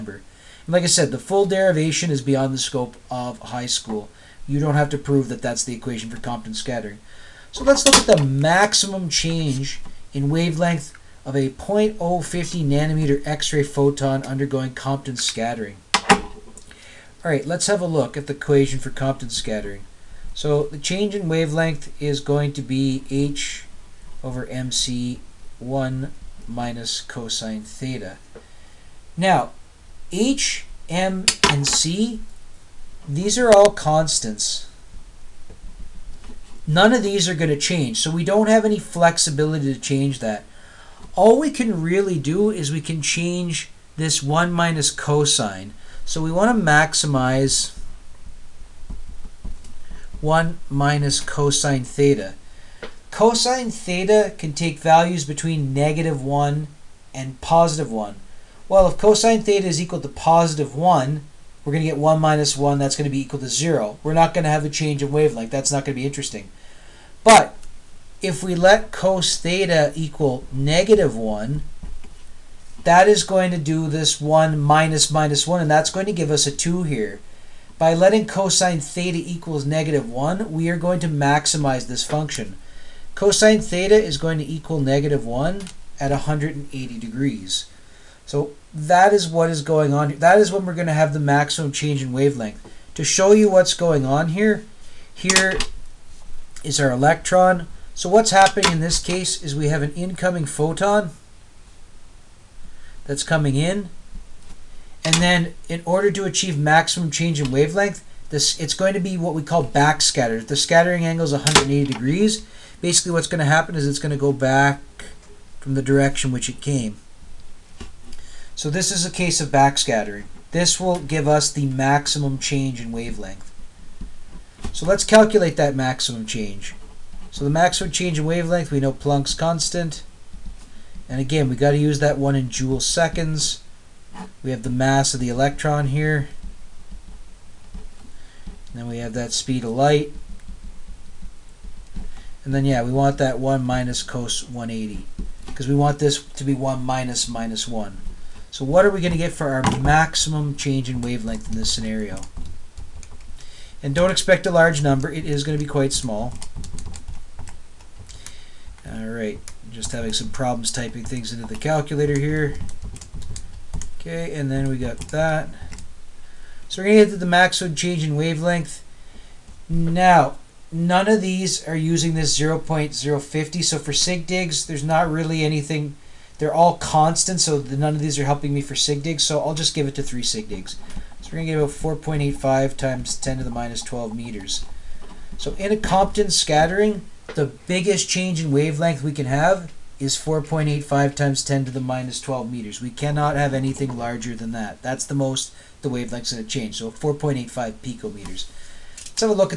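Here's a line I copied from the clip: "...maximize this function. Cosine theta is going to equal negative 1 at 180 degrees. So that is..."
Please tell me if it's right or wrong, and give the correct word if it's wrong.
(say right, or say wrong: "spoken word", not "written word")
right.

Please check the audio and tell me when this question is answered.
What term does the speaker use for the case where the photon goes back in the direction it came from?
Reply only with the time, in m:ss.
1:49.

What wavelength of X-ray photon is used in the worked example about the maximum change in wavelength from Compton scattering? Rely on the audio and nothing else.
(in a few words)
0.050 nanometers.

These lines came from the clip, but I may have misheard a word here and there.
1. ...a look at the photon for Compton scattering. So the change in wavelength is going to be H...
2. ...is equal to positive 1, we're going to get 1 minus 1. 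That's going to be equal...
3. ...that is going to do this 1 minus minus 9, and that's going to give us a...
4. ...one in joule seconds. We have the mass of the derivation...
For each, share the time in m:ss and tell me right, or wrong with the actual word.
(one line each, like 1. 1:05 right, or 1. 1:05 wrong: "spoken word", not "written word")
1. 0:17 wrong: "equation", not "photon"
2. 0:59 right
3. 1:12 wrong: "1", not "9"
4. 2:12 wrong: "electron", not "derivation".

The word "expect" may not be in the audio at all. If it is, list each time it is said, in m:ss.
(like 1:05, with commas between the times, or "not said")
2:34.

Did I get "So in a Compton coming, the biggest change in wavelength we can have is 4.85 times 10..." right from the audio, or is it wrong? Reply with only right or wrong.
wrong.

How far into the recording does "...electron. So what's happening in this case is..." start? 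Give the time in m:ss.
1:36.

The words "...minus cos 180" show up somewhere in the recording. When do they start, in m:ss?
2:23.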